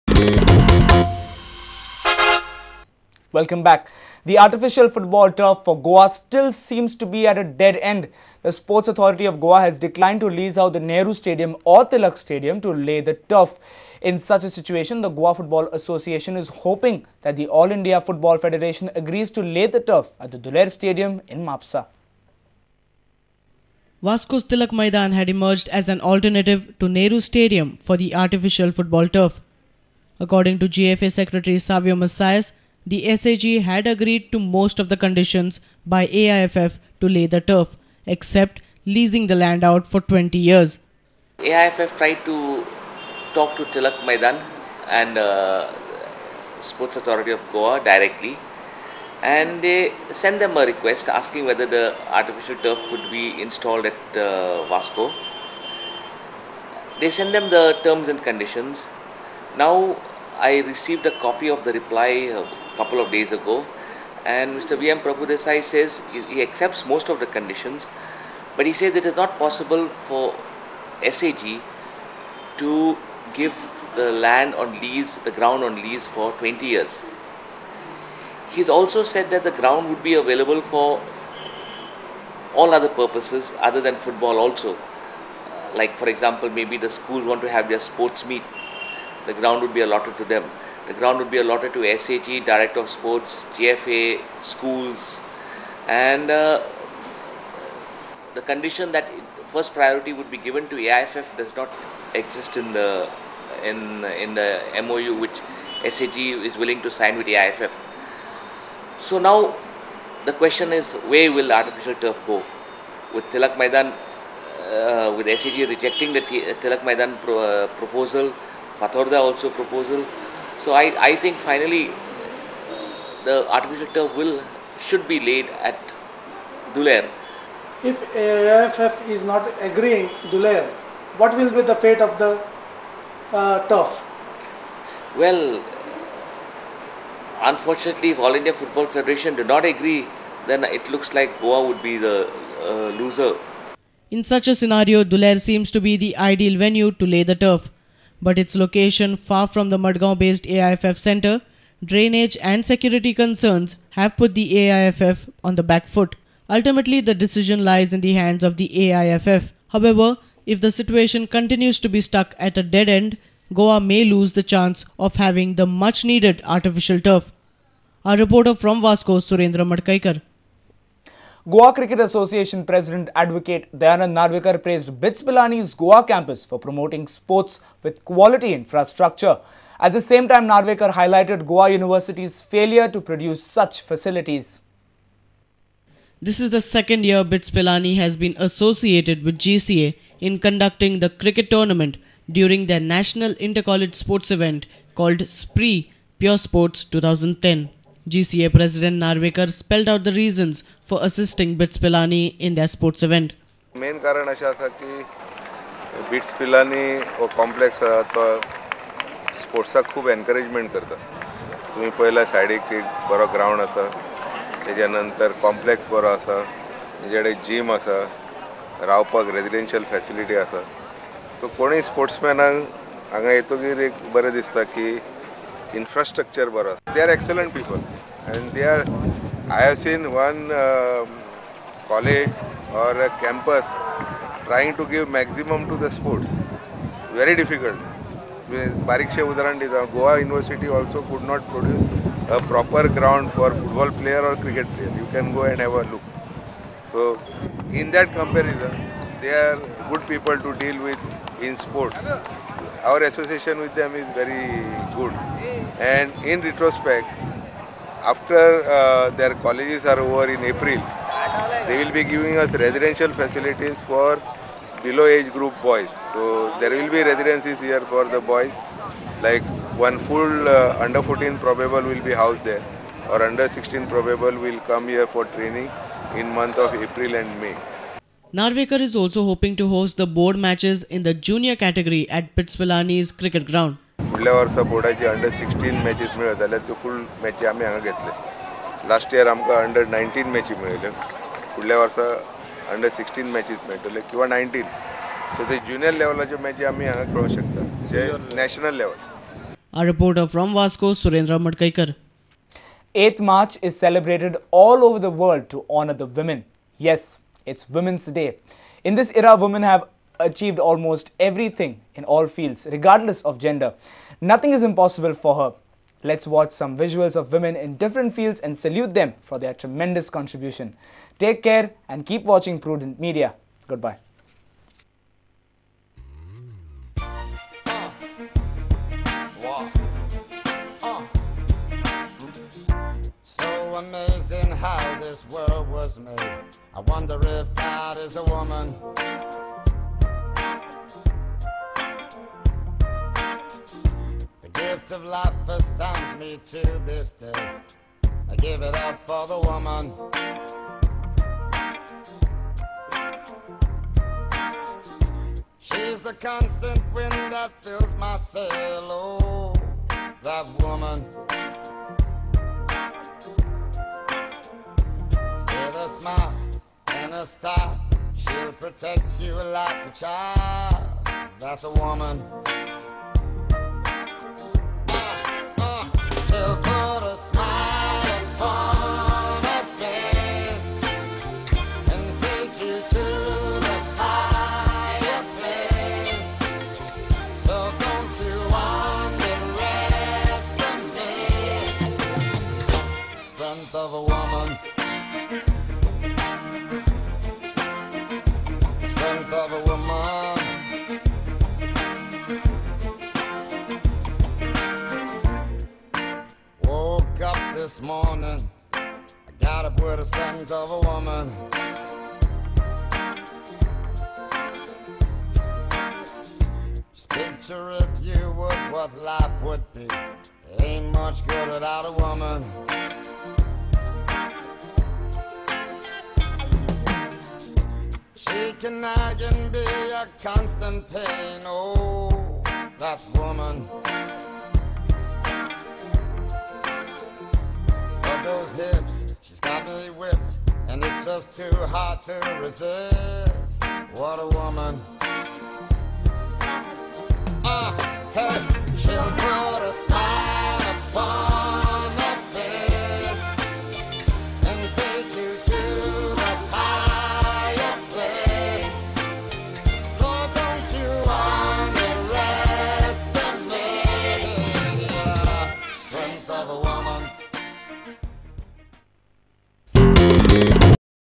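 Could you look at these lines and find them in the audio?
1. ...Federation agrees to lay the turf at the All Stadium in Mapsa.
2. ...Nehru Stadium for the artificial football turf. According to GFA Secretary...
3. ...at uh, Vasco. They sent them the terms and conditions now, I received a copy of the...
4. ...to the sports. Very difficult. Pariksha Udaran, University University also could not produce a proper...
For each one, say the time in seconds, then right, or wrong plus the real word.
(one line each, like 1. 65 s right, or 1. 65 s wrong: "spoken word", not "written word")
1. 18 s wrong: "Duler", not "All"
2. 26 s right
3. 53 s right
4. 235 s wrong: "Goa", not "University".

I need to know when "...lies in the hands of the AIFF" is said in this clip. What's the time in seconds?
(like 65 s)
157 s.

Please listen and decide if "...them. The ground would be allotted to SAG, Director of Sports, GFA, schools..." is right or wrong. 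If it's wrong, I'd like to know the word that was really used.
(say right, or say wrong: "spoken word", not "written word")
right.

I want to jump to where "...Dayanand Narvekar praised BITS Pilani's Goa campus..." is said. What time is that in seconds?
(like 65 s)
173 s.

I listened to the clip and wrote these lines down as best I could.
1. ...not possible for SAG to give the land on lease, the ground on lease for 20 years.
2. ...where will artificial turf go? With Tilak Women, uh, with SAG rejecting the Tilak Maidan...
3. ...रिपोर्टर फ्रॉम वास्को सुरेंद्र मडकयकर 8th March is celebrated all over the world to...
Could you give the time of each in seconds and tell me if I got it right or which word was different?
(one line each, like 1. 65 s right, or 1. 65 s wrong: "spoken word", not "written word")
1. 69 s right
2. 111 s wrong: "Maidan", not "Women"
3. 299 s right.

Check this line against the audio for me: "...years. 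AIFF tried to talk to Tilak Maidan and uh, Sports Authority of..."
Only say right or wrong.
right.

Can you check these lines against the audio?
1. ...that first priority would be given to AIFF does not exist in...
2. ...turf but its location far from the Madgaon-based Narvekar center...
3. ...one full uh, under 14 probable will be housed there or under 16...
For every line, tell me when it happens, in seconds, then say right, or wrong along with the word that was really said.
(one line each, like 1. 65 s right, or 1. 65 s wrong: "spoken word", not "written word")
1. 98 s right
2. 147 s wrong: "AIFF", not "Narvekar"
3. 269 s right.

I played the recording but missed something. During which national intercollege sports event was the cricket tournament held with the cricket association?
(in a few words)
SPREE.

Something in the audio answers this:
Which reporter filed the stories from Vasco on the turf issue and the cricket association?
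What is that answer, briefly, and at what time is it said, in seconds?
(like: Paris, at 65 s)
Surendra Madkaikar, at 169 s.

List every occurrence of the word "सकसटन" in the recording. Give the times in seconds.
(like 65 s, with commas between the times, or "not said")
285 s, 292 s.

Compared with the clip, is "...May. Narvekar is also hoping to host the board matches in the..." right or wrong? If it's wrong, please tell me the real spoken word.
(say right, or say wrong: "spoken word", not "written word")
right.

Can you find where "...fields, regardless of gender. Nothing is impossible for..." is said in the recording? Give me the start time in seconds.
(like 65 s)
312 s.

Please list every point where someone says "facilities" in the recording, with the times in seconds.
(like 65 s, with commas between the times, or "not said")
183 s, 263 s.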